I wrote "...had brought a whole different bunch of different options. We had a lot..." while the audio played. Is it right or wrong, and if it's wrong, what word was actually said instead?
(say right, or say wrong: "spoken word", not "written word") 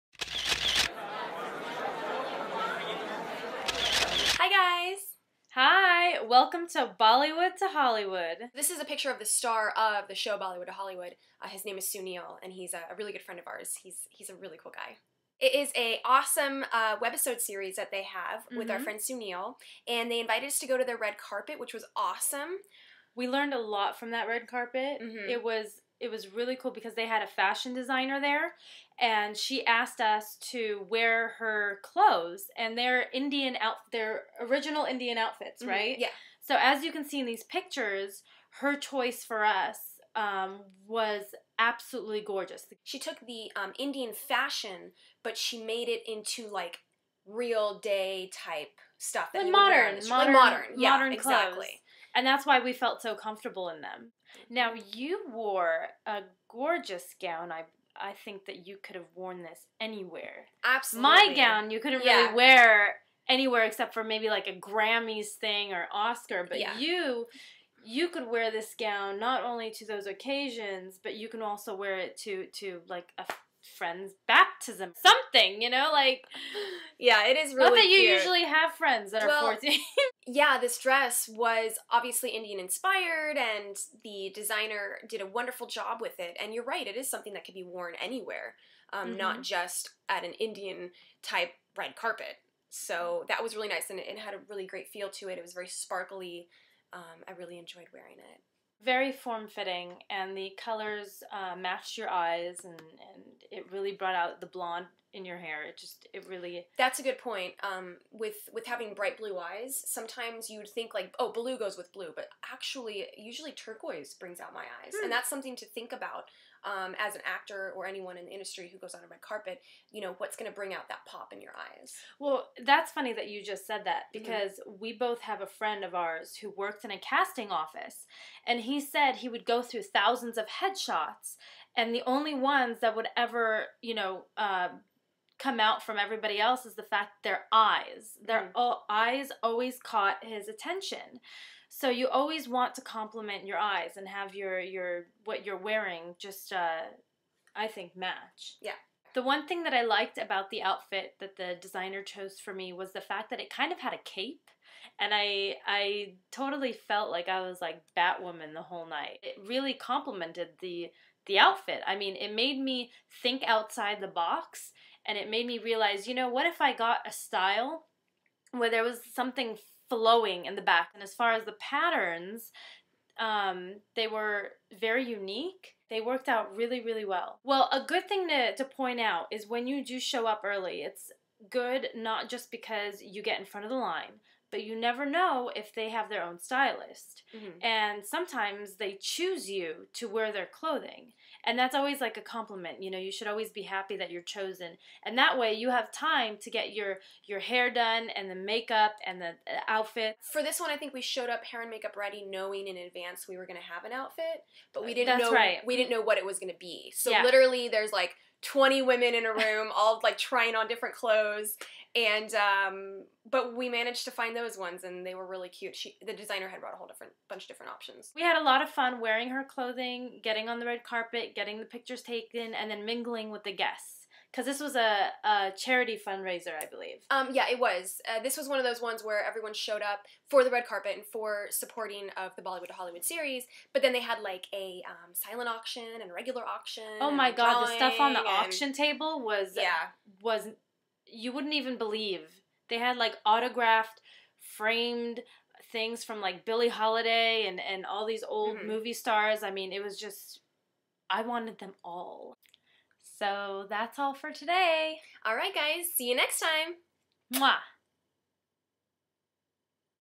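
right.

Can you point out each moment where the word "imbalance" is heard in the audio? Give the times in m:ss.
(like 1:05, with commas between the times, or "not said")
not said.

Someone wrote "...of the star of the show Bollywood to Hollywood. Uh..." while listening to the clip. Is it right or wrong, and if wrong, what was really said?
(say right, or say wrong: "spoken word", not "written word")
right.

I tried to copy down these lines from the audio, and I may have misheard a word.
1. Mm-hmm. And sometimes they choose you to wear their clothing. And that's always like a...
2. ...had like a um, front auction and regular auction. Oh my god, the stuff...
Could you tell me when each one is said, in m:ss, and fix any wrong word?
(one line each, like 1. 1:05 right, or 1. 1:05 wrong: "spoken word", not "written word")
1. 3:07 right
2. 3:53 wrong: "silent", not "front".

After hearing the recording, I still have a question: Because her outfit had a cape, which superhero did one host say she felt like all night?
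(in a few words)
Batwoman.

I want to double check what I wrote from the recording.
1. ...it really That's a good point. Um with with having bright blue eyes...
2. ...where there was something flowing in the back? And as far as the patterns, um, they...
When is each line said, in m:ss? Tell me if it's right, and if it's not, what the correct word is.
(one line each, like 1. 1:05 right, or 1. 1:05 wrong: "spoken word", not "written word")
1. 1:46 right
2. 2:48 right.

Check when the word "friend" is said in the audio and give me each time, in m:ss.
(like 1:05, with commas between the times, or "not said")
0:13, 0:18, 1:13, 1:18, 2:05.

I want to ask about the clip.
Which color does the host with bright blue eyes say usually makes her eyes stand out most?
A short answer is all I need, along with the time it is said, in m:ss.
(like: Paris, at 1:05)
Turquoise, at 1:53.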